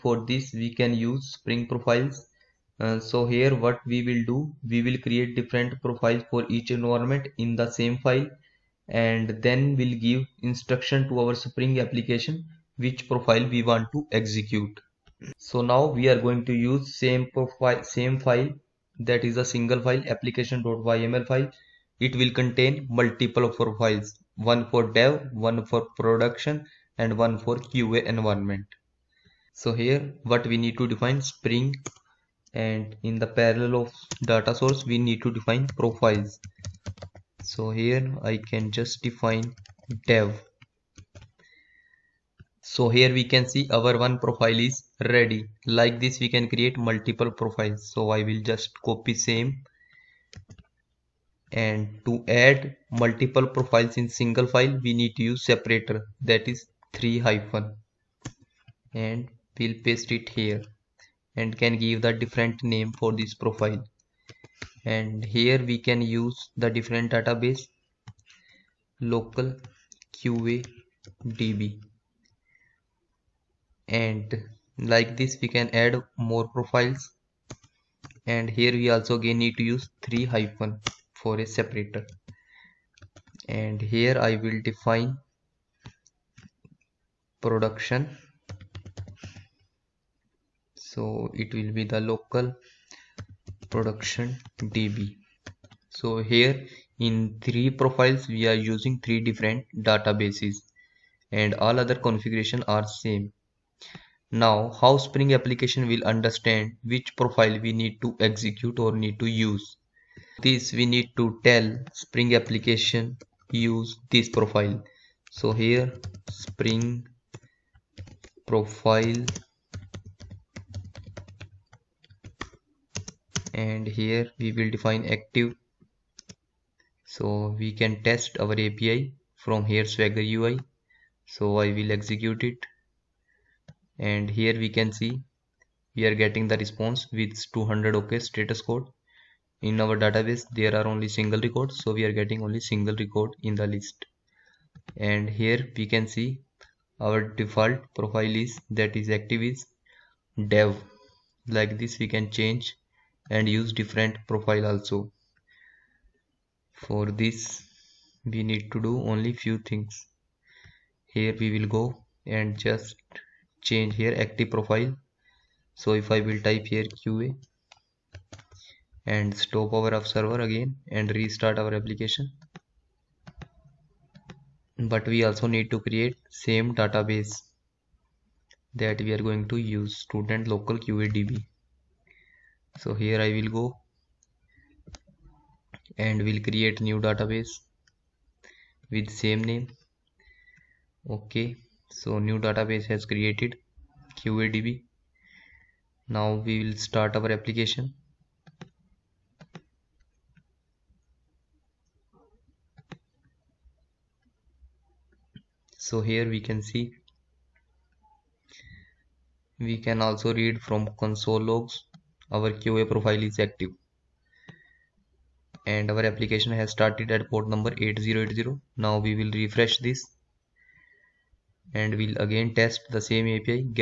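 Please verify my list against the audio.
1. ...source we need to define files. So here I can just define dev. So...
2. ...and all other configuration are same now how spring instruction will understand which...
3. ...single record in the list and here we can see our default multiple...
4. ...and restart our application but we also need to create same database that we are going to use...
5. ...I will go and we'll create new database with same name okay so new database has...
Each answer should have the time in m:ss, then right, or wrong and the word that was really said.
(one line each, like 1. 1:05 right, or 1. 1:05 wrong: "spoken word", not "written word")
1. 0:34 wrong: "profiles", not "files"
2. 1:41 wrong: "application", not "instruction"
3. 2:22 wrong: "profile", not "multiple"
4. 2:51 right
5. 3:03 right.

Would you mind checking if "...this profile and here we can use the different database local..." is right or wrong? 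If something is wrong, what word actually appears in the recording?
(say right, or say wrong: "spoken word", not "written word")
right.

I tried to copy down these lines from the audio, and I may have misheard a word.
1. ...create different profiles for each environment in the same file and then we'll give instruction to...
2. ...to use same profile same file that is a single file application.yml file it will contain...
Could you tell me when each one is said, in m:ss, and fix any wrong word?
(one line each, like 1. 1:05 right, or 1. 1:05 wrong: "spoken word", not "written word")
1. 0:05 right
2. 0:16 right.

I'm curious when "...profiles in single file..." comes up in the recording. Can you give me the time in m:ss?
0:53.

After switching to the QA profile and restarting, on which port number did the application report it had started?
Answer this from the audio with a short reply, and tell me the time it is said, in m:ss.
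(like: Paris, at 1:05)
8080, at 3:37.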